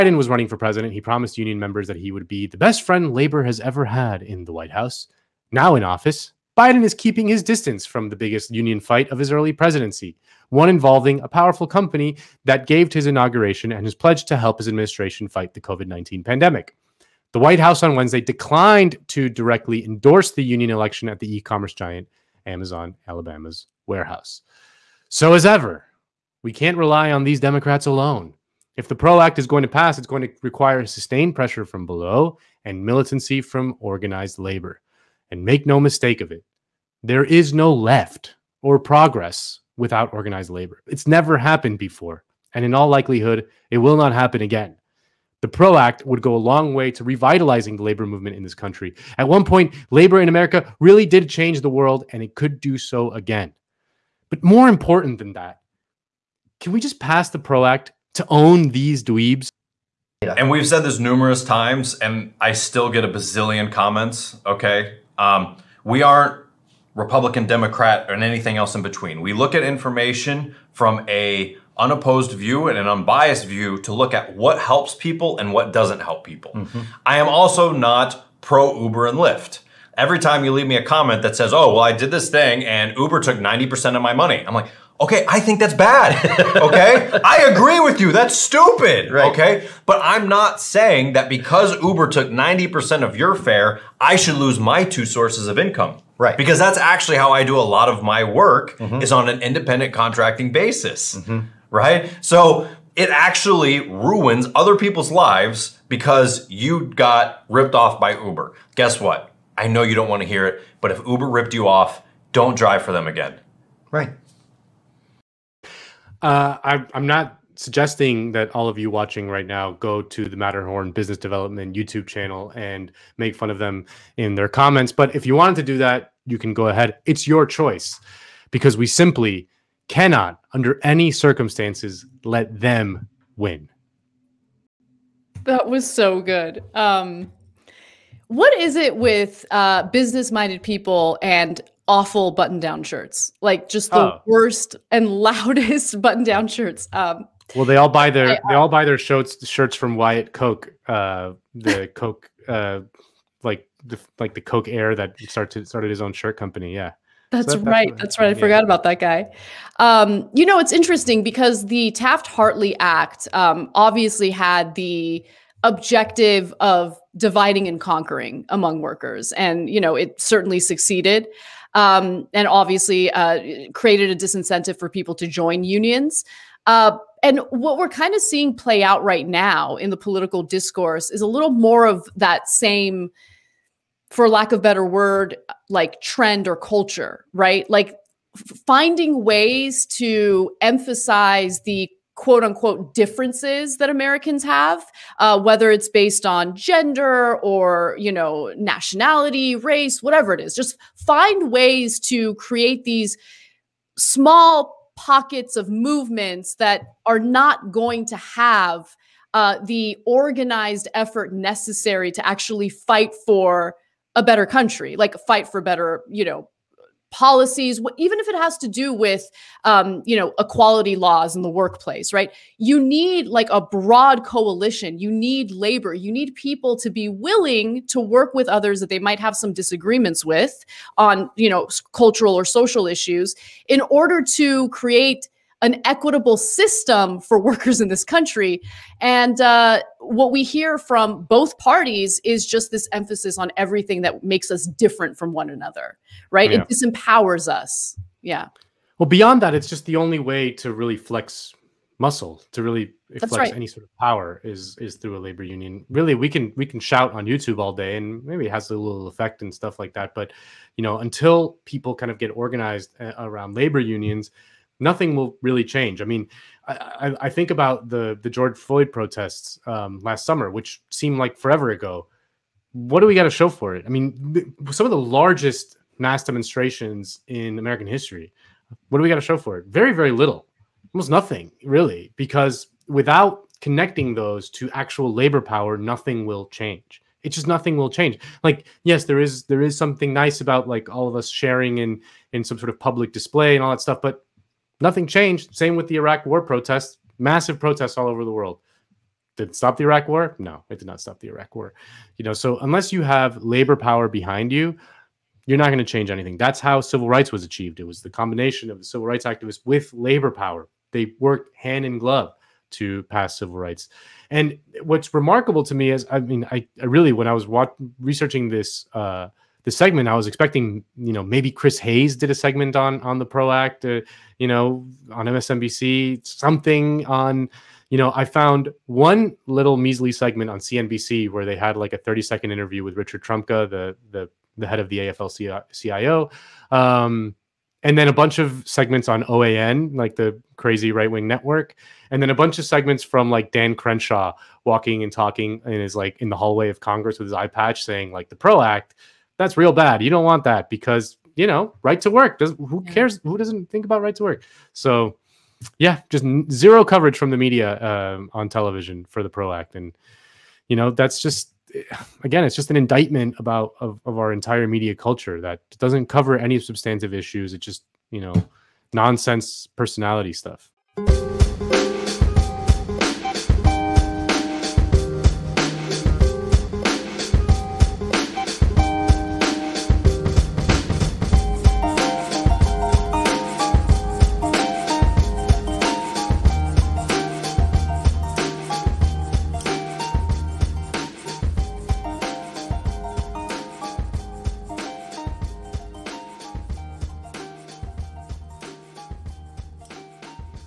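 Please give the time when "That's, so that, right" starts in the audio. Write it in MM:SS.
02:37.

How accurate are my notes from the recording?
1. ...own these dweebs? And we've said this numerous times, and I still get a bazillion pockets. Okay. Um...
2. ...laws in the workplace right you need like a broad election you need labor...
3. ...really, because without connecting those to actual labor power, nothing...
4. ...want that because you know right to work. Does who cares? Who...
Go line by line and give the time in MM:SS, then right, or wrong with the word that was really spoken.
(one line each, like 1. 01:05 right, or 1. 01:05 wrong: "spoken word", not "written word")
1. 00:58 wrong: "comments", not "pockets"
2. 03:40 wrong: "coalition", not "election"
3. 04:41 right
4. 05:50 right.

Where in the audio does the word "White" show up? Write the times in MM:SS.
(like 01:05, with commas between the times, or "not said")
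00:04, 00:17.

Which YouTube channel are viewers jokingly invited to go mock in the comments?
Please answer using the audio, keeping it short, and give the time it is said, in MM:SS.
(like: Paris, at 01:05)
Matterhorn Business Development, at 02:00.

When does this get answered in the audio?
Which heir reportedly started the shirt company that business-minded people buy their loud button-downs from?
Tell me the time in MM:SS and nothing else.
02:29.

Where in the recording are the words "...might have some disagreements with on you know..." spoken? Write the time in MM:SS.
03:48.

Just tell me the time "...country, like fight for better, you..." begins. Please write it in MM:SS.
03:34.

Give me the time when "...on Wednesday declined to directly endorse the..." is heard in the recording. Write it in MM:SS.
00:17.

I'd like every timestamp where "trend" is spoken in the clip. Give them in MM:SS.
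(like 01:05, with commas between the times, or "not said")
03:05.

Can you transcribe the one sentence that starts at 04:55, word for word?
Same with the Iraq war protests, massive protests all over the world.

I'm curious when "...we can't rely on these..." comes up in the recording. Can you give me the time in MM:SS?
00:26.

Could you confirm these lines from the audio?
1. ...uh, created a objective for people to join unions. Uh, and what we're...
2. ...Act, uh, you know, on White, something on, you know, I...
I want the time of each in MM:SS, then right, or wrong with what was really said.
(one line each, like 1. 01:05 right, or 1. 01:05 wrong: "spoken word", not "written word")
1. 02:53 wrong: "disincentive", not "objective"
2. 05:23 wrong: "MSNBC", not "White".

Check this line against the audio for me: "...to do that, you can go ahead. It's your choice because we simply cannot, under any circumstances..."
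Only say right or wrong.
right.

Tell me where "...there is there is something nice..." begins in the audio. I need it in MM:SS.
04:49.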